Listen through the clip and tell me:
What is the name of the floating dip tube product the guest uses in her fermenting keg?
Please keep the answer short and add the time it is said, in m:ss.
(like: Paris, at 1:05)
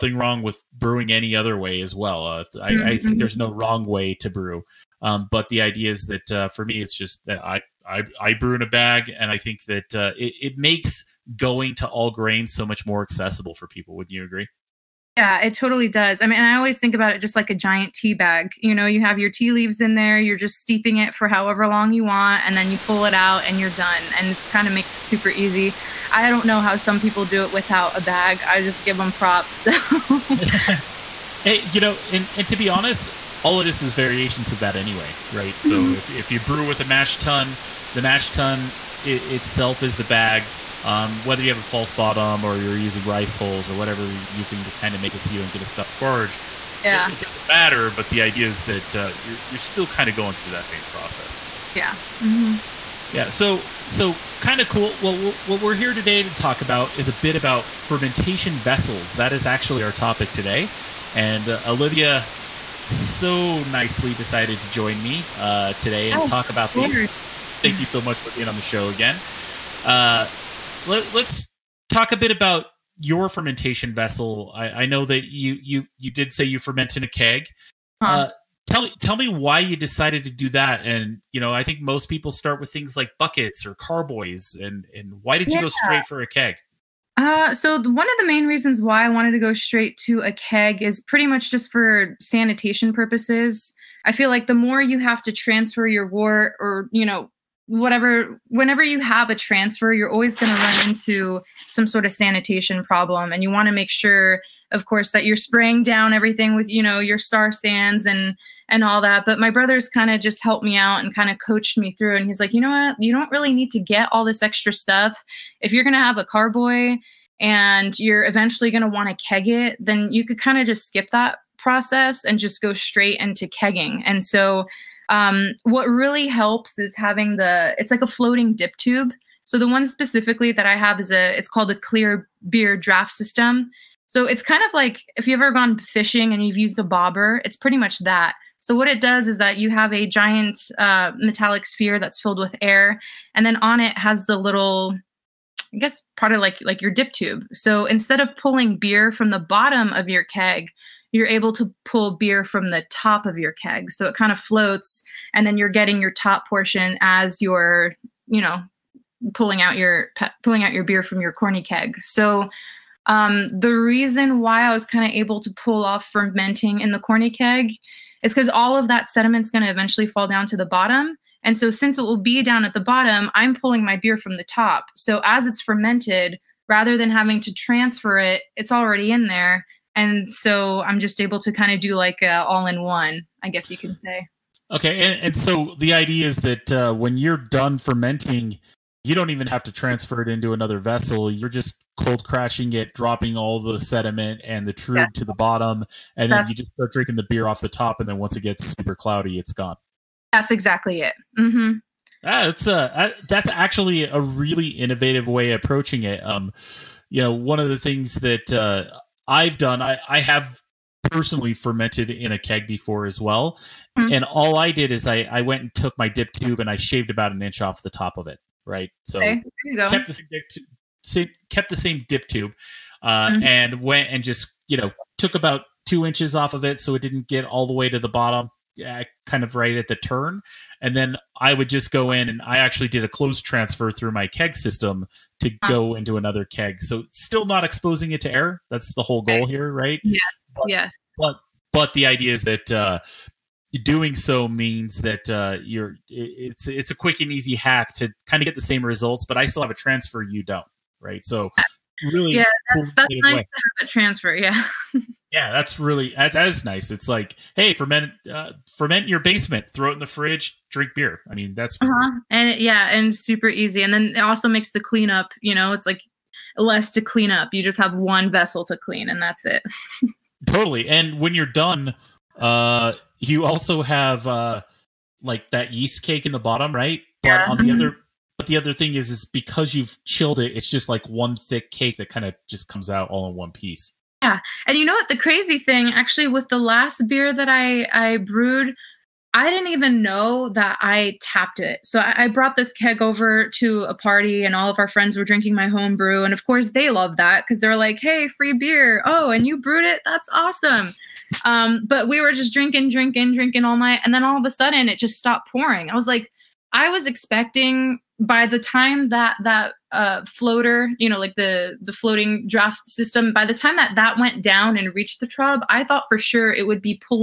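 clear beer draft system, at 2:11.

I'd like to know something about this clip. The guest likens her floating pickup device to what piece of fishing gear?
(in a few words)
a bobber.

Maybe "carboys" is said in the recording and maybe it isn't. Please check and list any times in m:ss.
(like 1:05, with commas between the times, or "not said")
1:23, 1:56.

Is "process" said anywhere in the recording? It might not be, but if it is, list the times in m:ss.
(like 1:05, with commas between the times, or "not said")
0:50, 2:01.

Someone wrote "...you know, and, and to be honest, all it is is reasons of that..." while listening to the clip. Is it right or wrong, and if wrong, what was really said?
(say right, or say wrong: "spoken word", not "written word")
wrong: "variations", not "reasons".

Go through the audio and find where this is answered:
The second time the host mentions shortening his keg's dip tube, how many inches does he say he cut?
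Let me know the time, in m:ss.
3:45.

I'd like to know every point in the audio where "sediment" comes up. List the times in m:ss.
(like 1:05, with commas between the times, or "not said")
2:49, 3:13.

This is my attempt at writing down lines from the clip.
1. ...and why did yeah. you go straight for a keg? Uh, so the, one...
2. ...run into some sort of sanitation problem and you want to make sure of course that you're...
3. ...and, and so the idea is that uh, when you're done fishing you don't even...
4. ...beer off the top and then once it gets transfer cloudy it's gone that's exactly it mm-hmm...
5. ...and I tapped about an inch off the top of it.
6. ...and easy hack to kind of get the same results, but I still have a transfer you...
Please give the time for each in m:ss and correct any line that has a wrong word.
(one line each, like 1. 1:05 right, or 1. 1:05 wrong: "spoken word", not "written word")
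1. 1:24 right
2. 1:40 right
3. 3:05 wrong: "fermenting", not "fishing"
4. 3:17 wrong: "super", not "transfer"
5. 3:36 wrong: "shaved", not "tapped"
6. 4:07 right.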